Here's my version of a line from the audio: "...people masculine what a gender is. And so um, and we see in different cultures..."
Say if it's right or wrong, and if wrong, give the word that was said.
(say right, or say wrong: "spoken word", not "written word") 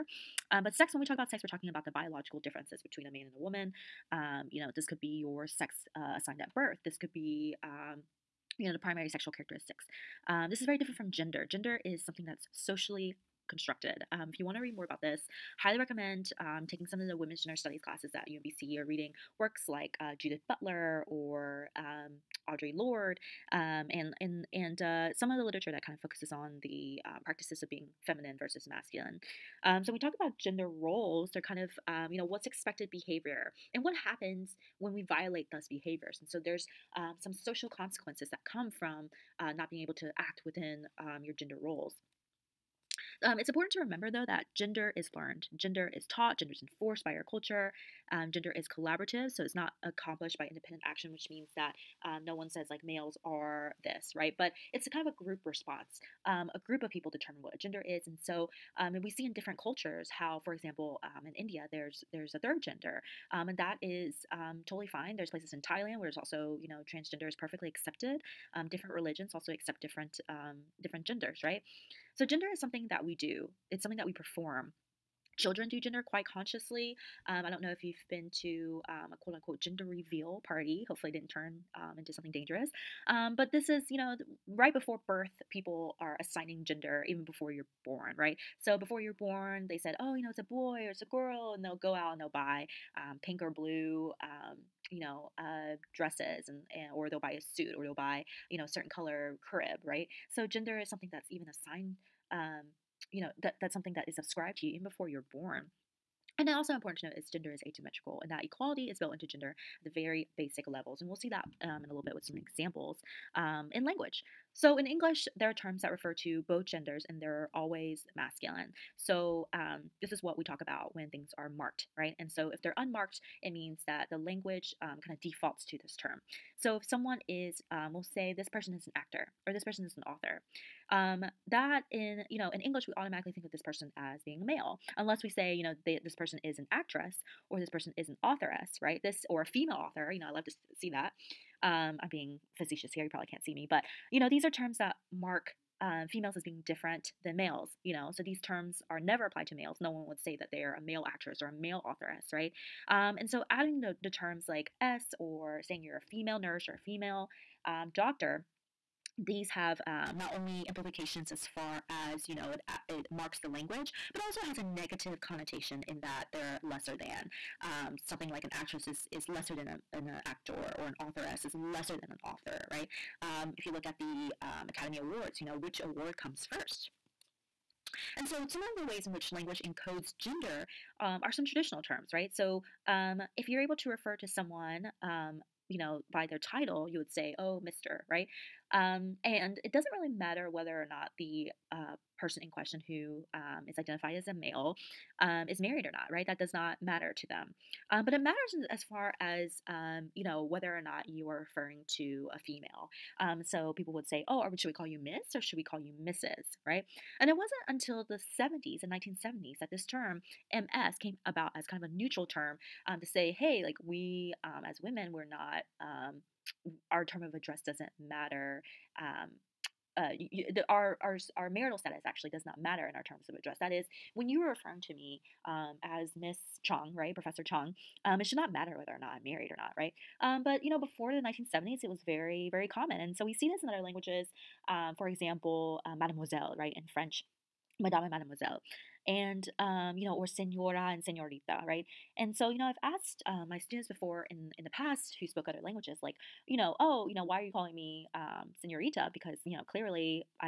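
wrong: "determine", not "masculine".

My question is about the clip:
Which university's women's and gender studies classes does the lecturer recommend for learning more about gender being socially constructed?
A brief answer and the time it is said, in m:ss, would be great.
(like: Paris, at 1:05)
UMBC, at 0:18.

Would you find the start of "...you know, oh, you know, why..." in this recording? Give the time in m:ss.
4:06.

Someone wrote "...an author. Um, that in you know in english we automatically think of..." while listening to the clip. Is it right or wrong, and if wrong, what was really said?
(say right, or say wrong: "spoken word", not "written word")
right.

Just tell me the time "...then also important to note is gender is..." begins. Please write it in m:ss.
1:46.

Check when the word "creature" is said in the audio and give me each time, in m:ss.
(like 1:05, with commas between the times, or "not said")
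not said.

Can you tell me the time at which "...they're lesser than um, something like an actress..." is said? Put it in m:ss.
2:46.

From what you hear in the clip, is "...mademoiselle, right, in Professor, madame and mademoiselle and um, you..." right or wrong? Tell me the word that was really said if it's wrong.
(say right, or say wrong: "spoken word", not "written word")
wrong: "French", not "Professor".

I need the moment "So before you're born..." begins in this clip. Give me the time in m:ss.
1:28.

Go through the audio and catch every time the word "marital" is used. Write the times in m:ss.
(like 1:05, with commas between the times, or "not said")
3:41.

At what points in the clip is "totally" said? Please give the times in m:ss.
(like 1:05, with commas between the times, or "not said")
1:04.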